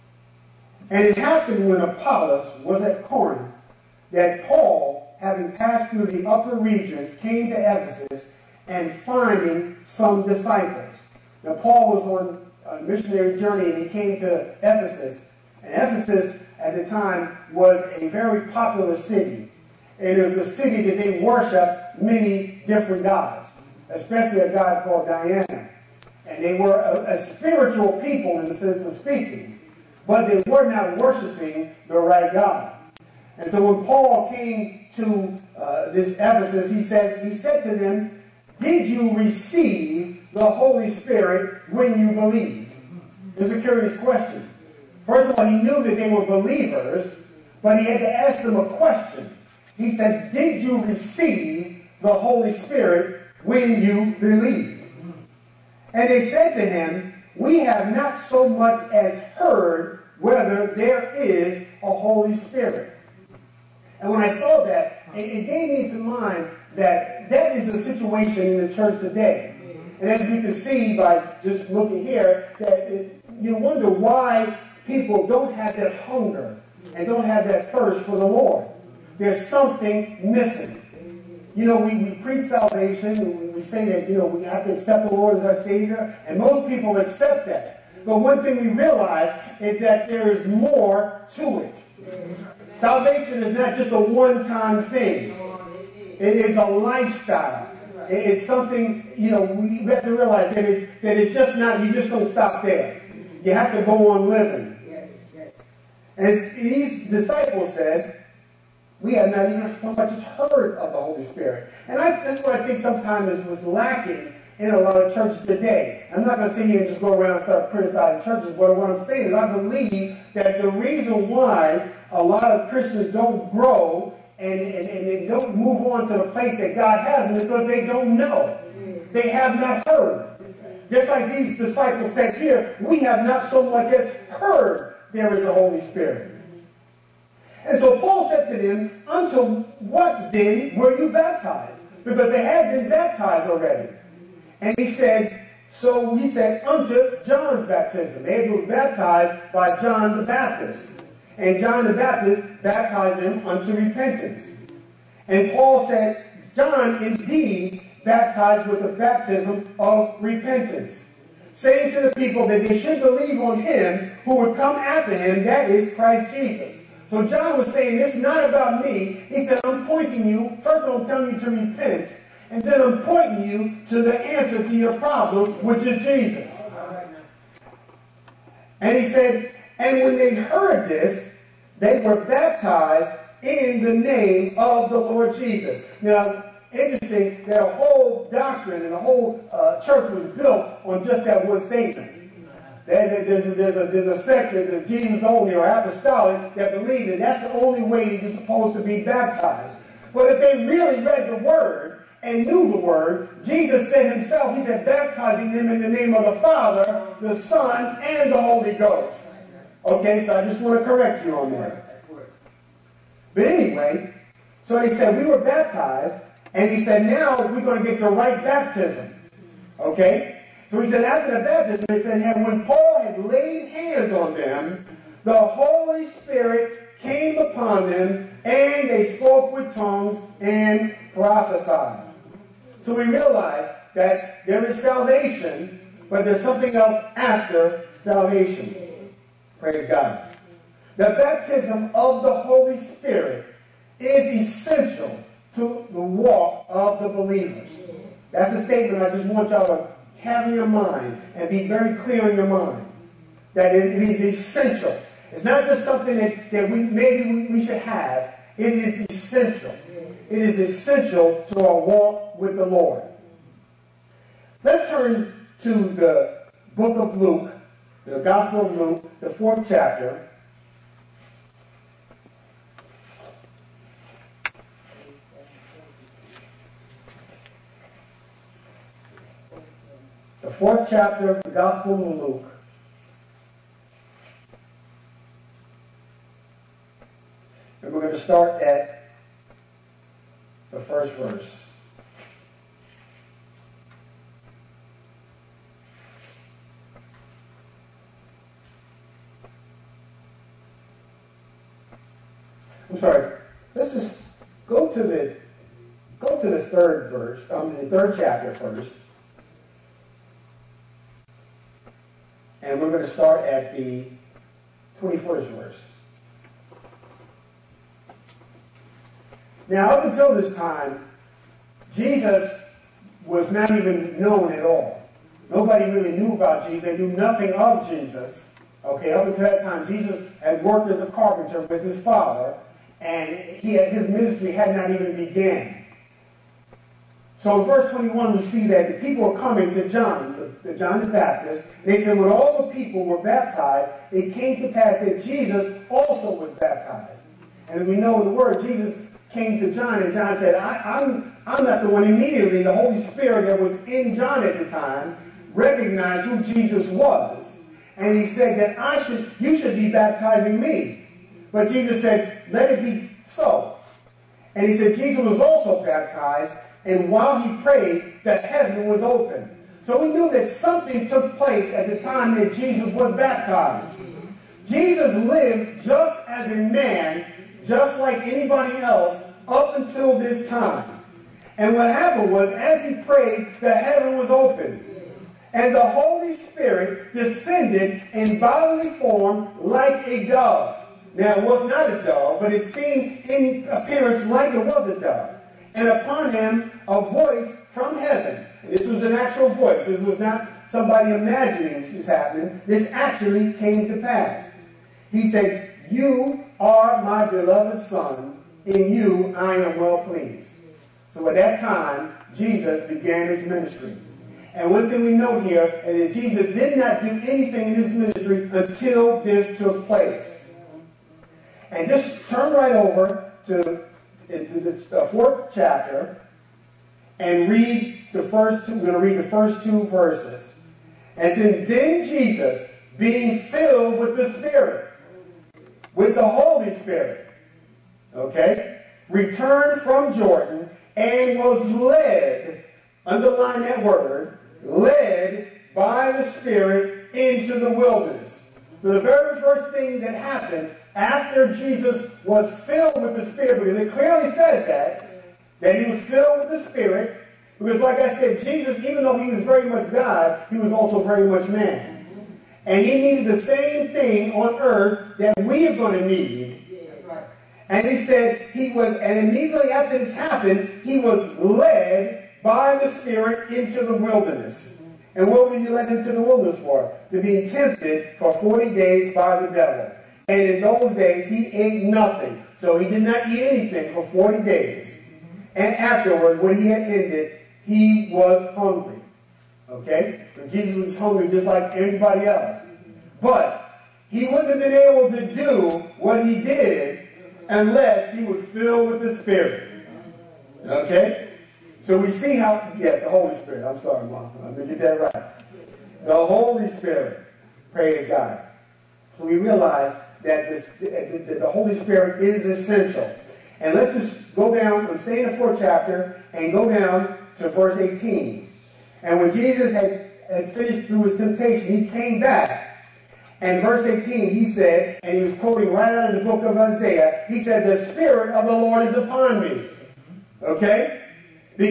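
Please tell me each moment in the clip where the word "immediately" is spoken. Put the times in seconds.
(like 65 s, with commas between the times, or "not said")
352 s, 469 s.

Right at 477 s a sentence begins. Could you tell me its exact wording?
To be tempted for 40 days by the devil.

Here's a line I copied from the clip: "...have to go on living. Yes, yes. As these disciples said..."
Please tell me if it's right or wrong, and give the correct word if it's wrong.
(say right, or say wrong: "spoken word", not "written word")
right.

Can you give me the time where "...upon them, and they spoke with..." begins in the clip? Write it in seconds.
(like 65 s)
227 s.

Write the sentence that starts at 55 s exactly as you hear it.
And they said to him, We have not so much as heard whether there is a Holy Spirit.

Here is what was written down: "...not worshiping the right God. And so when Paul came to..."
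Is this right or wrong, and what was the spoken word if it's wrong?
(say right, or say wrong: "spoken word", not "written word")
right.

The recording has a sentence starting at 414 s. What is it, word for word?
And one thing we know here is that Jesus did not do anything in his ministry until this took place.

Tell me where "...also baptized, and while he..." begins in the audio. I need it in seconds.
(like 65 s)
365 s.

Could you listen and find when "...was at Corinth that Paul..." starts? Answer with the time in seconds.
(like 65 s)
2 s.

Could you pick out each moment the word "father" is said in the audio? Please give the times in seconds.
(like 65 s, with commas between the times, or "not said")
206 s, 332 s.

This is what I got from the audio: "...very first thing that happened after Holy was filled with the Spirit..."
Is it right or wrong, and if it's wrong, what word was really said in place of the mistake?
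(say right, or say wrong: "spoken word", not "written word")
wrong: "Jesus", not "Holy".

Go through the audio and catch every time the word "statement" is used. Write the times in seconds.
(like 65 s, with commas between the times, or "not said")
191 s, 248 s.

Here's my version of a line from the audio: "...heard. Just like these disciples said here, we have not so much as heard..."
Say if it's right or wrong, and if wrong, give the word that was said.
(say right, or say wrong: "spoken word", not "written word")
right.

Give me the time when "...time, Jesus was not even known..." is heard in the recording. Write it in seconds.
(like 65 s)
320 s.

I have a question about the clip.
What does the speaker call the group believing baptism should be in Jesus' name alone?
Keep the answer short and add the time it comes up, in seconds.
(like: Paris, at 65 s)
Jesus only or apostolic, at 194 s.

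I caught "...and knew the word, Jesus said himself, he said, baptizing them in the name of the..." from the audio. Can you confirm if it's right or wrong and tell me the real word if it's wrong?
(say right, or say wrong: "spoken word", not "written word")
right.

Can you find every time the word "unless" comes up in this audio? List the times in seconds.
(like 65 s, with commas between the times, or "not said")
497 s.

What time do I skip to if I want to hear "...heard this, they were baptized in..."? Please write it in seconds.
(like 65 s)
180 s.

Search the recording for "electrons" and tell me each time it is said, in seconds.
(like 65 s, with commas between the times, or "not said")
not said.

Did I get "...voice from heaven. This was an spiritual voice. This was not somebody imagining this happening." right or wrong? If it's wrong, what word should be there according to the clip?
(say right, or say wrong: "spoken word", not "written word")
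wrong: "actual", not "spiritual".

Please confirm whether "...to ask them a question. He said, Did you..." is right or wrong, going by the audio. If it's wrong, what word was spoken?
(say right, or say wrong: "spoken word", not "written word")
right.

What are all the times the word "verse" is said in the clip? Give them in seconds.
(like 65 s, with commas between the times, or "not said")
291 s, 307 s, 315 s, 337 s, 429 s, 517 s, 523 s.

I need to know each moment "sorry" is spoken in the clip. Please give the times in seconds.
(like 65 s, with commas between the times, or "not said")
303 s, 503 s.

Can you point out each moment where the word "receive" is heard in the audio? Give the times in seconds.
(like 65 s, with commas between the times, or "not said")
39 s, 50 s.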